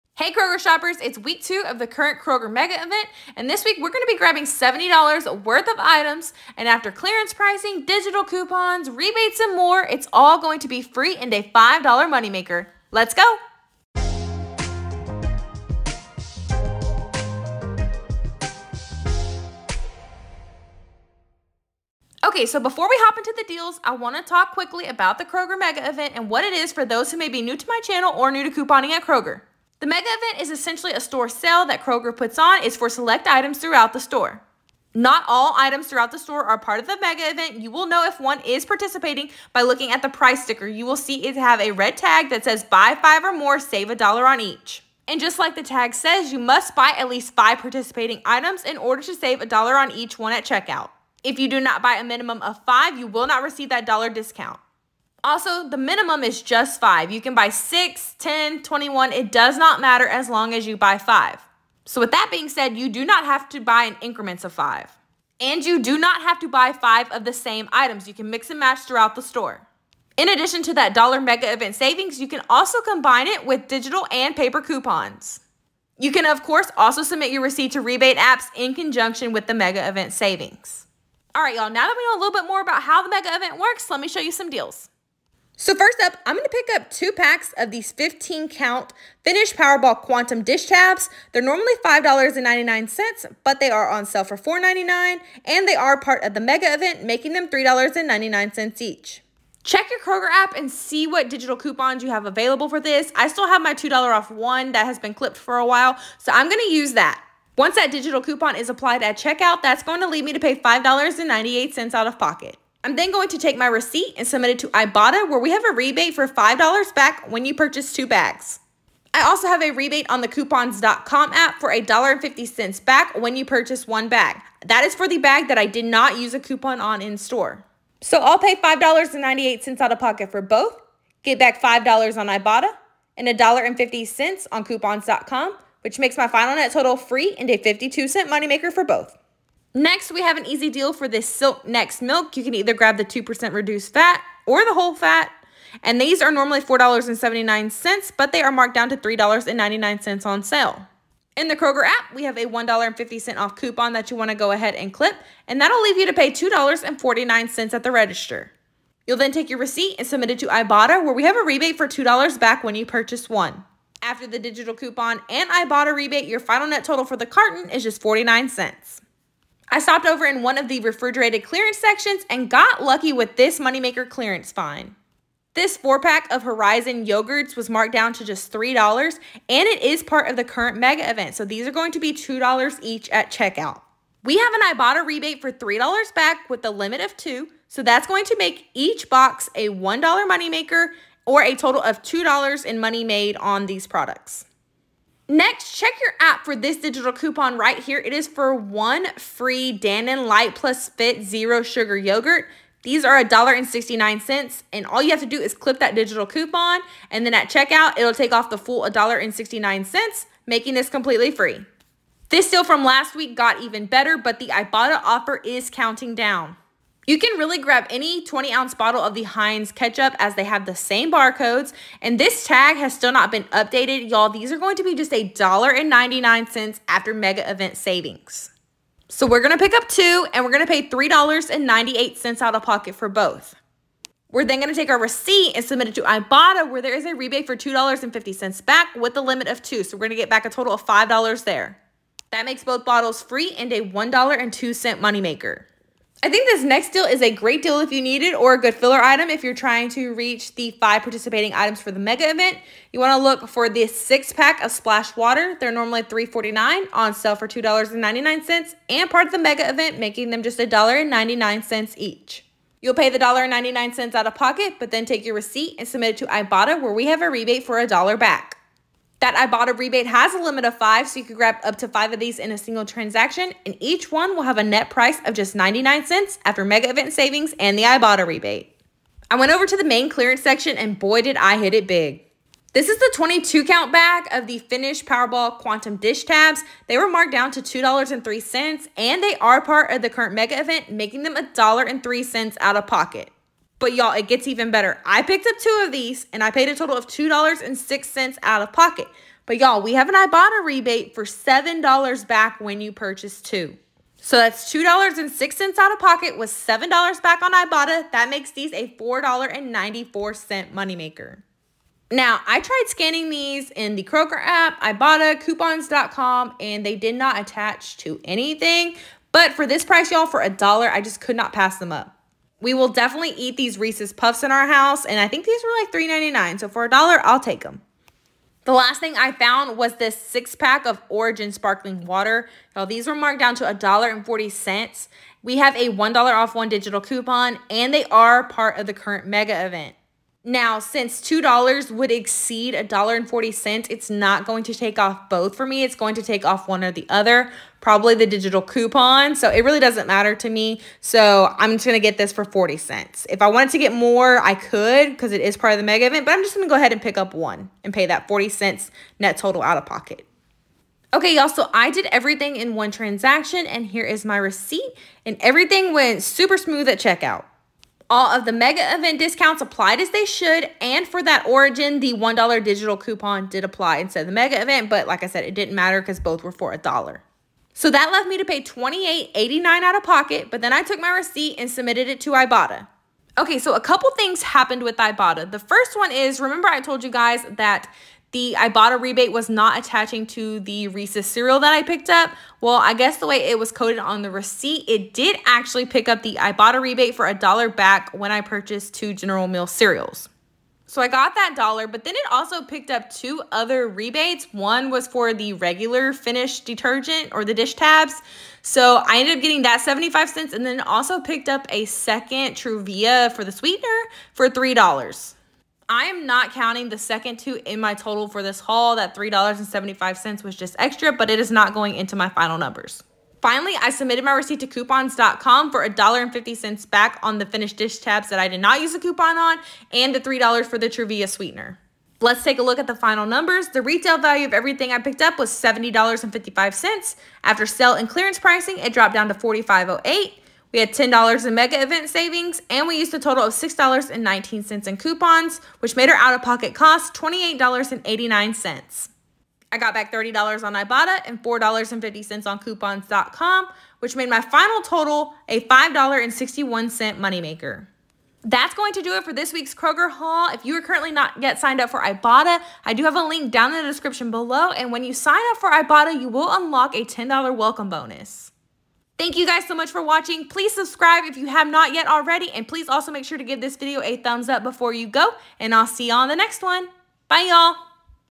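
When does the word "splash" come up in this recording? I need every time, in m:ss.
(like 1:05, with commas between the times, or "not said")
4:14.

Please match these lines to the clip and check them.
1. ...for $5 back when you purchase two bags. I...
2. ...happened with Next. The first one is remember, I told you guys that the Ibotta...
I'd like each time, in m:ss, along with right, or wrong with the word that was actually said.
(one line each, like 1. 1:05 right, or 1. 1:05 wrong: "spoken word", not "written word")
1. 1:56 right
2. 6:24 wrong: "Ibotta", not "Next".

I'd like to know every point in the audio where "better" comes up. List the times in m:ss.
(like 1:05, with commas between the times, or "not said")
3:33, 4:54.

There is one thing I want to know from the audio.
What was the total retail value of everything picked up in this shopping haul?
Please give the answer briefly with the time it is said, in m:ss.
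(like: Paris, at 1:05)
$70.55, at 7:15.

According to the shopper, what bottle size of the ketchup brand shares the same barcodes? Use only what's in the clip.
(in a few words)
20 ounce.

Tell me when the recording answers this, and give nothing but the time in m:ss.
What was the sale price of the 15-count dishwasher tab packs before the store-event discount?
1:34.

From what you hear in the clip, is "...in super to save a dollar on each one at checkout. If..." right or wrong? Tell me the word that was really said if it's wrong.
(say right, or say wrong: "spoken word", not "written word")
wrong: "order", not "super".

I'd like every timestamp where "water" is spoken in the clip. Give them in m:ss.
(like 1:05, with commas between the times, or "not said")
4:15, 5:32.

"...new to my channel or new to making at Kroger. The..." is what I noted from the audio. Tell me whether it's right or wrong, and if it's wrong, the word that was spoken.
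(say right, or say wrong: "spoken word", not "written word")
wrong: "couponing", not "making".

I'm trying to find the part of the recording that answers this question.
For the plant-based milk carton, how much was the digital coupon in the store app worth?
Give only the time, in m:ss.
2:32.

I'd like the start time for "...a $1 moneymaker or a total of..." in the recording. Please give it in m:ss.
3:09.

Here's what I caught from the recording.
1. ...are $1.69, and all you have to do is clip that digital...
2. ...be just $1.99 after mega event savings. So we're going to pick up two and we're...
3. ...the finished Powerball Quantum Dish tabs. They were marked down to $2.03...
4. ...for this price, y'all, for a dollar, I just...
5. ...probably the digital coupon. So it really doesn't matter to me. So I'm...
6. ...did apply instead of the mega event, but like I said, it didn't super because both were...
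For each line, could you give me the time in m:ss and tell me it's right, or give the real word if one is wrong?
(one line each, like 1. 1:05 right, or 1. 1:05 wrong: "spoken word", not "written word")
1. 3:23 right
2. 3:44 right
3. 4:44 right
4. 5:19 right
5. 5:47 right
6. 6:13 wrong: "matter", not "super".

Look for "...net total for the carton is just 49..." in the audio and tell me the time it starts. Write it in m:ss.
2:46.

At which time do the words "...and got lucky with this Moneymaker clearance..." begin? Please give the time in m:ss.
2:52.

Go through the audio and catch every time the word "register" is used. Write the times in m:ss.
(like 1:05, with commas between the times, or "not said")
2:37.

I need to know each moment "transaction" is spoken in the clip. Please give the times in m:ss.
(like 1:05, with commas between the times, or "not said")
4:32, 6:02.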